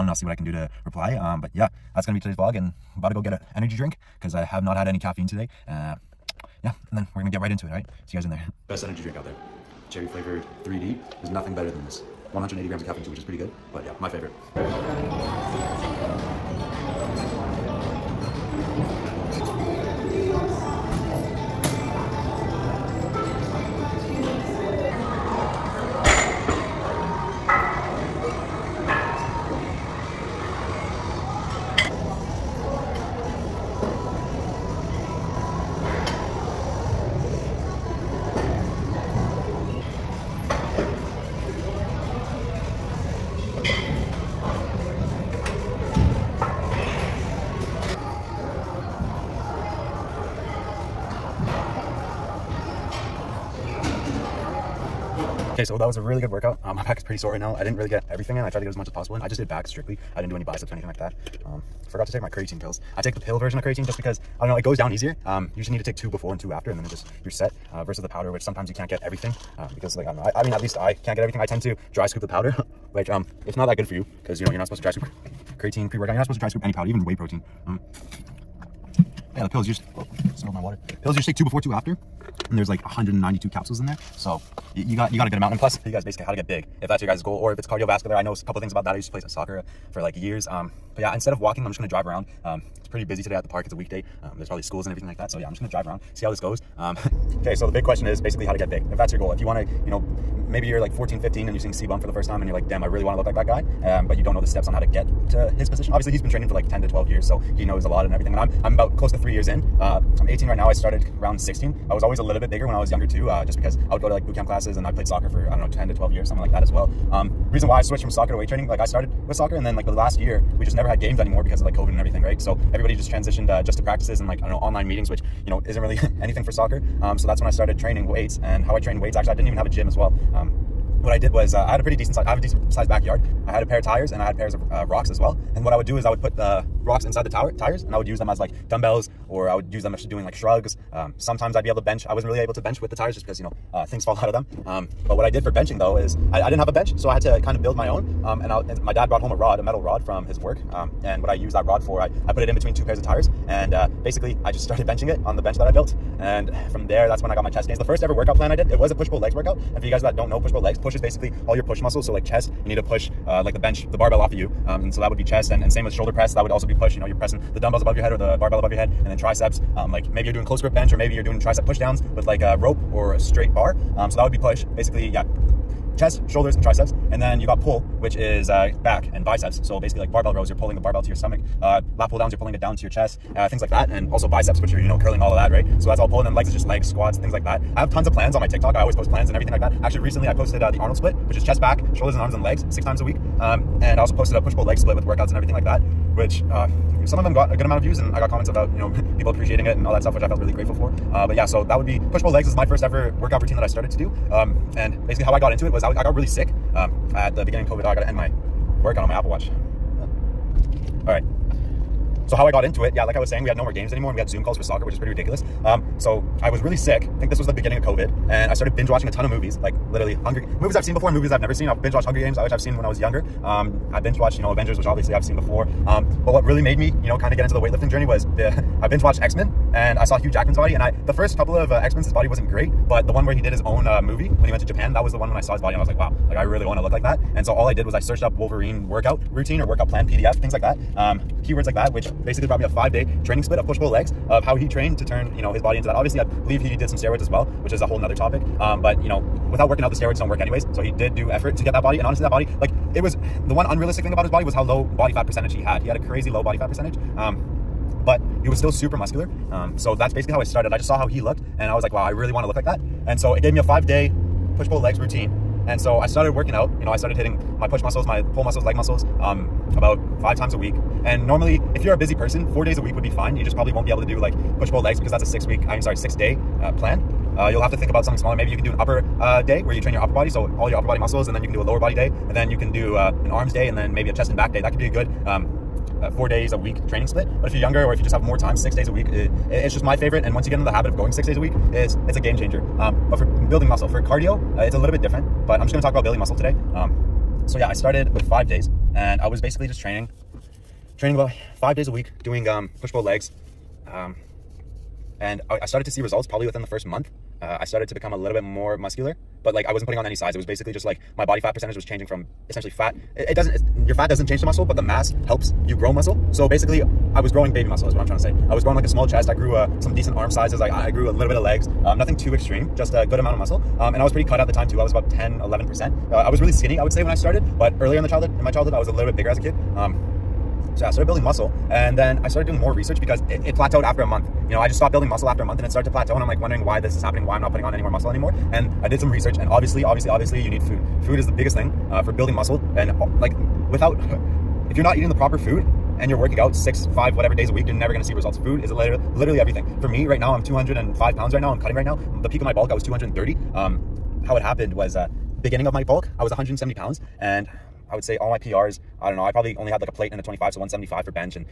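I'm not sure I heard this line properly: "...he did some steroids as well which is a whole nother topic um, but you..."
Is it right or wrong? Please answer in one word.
right.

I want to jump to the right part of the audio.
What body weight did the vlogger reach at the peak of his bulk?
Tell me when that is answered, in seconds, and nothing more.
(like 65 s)
352 s.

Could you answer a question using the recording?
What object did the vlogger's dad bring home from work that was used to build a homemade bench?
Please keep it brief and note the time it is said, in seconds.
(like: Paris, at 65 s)
A metal rod, at 149 s.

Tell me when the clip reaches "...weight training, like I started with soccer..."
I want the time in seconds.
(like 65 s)
118 s.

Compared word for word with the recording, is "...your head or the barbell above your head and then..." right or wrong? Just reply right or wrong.
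right.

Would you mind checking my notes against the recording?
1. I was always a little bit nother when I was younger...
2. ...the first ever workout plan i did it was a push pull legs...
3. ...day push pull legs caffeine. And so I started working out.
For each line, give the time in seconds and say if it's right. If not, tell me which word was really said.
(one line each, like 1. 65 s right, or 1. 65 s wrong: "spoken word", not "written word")
1. 111 s wrong: "bigger", not "nother"
2. 157 s right
3. 263 s wrong: "routine", not "caffeine".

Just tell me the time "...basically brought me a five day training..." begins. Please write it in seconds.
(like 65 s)
242 s.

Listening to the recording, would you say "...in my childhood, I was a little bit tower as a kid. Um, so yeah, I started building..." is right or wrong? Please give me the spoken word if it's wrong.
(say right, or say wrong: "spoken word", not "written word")
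wrong: "bigger", not "tower".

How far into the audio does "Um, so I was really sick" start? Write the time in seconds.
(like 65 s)
215 s.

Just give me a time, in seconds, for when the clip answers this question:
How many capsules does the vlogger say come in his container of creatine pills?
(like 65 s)
82 s.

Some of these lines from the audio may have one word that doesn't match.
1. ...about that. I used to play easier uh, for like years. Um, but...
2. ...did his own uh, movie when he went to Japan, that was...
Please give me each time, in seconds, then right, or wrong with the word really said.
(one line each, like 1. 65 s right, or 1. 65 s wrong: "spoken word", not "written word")
1. 88 s wrong: "soccer", not "easier"
2. 233 s right.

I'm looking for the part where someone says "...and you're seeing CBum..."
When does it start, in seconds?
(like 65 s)
101 s.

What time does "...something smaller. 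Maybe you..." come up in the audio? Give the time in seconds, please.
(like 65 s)
278 s.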